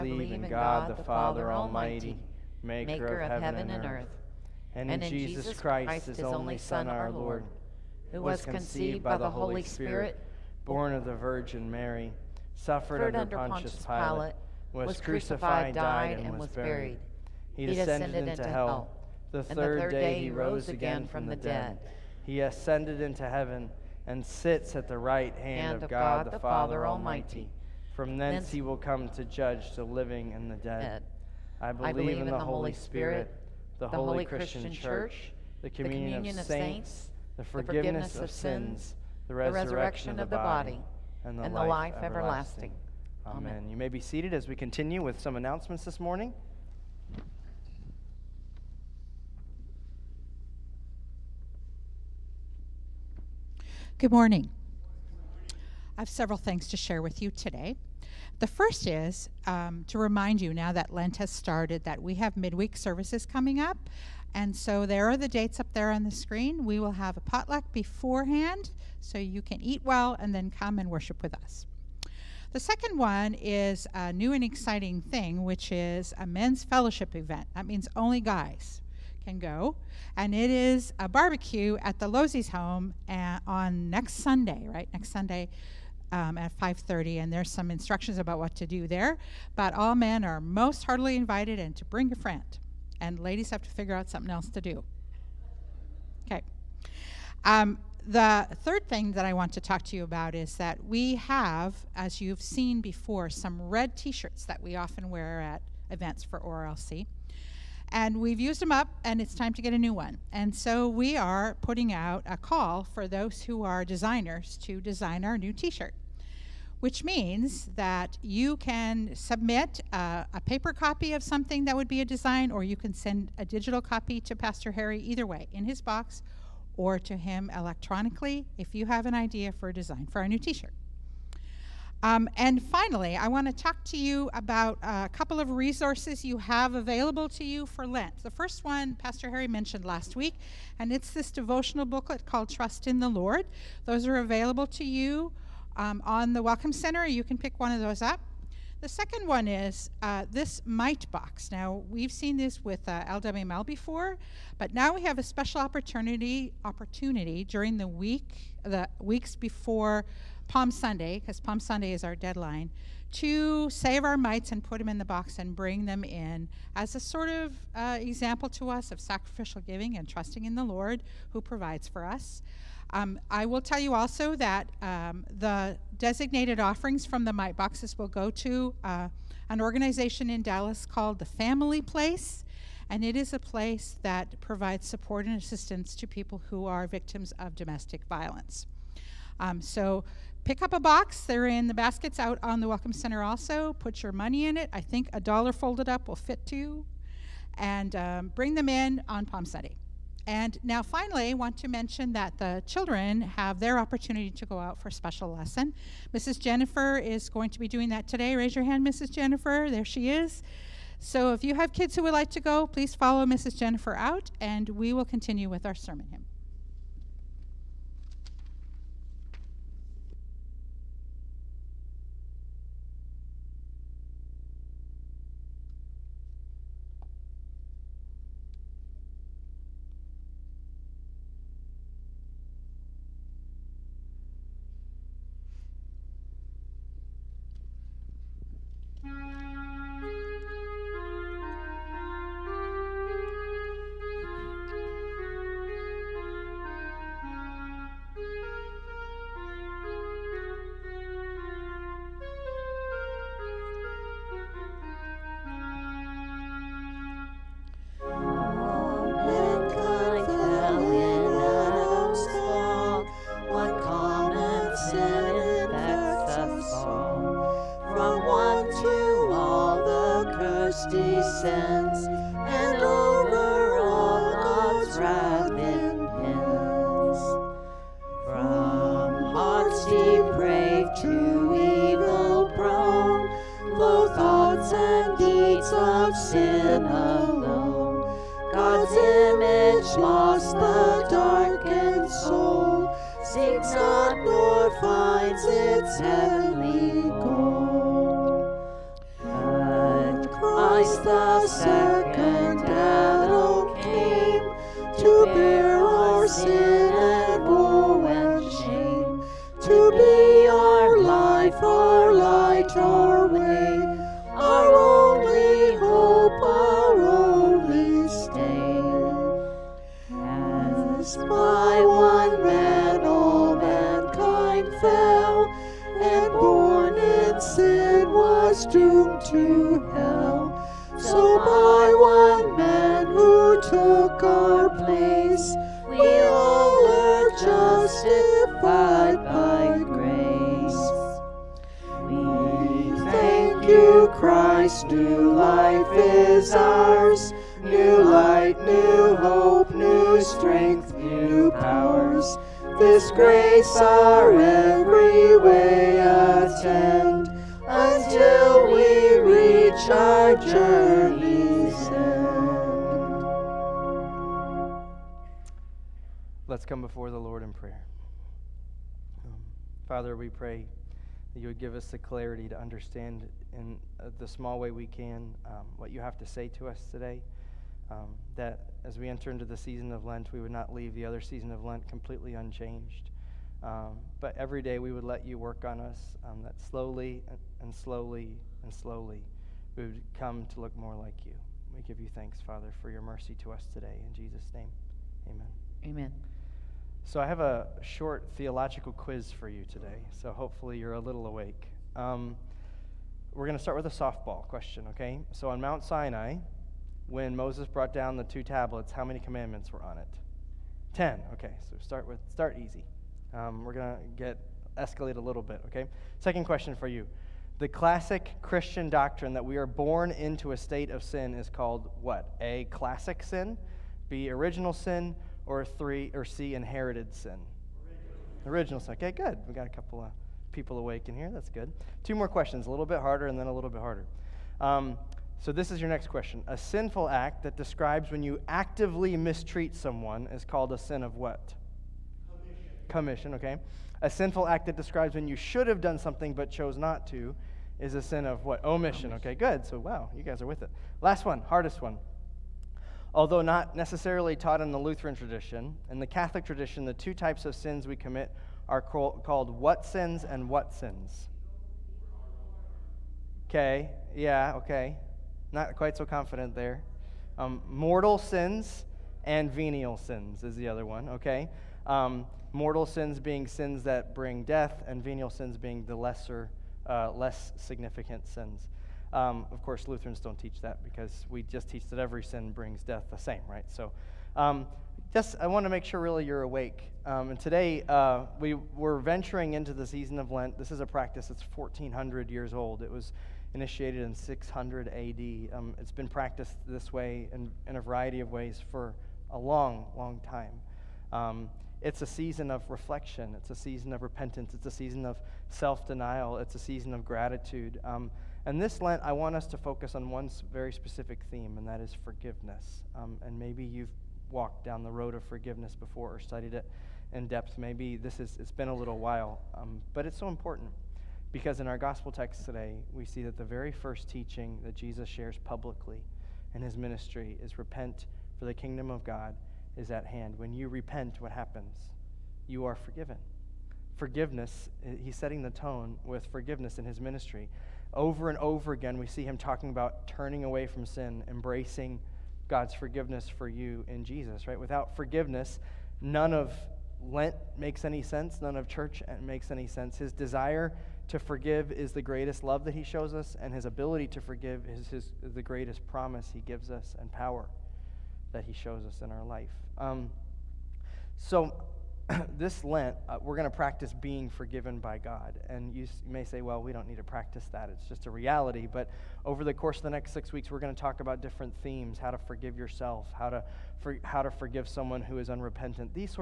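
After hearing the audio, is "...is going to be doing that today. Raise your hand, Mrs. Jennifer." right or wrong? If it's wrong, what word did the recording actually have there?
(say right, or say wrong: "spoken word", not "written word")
right.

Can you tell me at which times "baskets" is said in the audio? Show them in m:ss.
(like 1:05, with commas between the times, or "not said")
3:11.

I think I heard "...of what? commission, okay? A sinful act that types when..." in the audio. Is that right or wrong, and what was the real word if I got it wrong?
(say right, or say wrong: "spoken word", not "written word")
wrong: "describes", not "types".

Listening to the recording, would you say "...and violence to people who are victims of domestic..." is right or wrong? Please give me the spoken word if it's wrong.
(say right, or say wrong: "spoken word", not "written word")
wrong: "assistance", not "violence".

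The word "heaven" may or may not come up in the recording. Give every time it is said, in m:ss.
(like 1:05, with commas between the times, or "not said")
0:03, 0:23.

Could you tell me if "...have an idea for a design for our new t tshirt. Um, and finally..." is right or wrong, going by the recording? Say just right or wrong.
wrong.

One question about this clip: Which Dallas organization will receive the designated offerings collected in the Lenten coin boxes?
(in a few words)
The Family Place.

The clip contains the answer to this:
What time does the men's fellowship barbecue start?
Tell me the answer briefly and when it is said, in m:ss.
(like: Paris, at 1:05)
5:30, at 1:26.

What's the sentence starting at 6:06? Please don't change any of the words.
Let's come before the Lord in prayer.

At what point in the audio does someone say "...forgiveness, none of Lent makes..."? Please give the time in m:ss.
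9:04.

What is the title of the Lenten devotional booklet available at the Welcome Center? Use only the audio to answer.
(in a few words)
Trust in the Lord.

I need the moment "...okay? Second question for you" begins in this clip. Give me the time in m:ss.
6:55.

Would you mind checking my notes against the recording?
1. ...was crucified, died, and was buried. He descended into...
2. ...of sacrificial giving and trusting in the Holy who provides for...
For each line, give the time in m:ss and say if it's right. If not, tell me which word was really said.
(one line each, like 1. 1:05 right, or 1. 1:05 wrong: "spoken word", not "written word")
1. 0:14 right
2. 2:48 wrong: "Lord", not "Holy".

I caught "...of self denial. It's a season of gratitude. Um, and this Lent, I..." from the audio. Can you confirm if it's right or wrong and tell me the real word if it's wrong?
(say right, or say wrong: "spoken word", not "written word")
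right.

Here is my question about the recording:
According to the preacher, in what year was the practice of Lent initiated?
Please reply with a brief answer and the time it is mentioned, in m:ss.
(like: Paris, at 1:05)
600 AD, at 8:14.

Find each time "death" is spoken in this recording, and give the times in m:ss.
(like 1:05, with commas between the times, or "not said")
7:54, 8:02.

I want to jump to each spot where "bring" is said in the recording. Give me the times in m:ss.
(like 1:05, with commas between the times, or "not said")
1:31, 2:45, 3:18, 7:54, 8:02.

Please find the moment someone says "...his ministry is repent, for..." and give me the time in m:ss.
8:46.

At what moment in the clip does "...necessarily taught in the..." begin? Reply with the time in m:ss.
7:33.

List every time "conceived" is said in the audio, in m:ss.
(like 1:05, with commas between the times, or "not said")
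0:08.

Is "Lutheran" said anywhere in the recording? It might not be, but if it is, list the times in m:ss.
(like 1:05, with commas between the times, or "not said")
7:34, 7:59.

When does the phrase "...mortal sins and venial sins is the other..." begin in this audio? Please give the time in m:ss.
7:47.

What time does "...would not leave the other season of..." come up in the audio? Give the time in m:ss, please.
6:20.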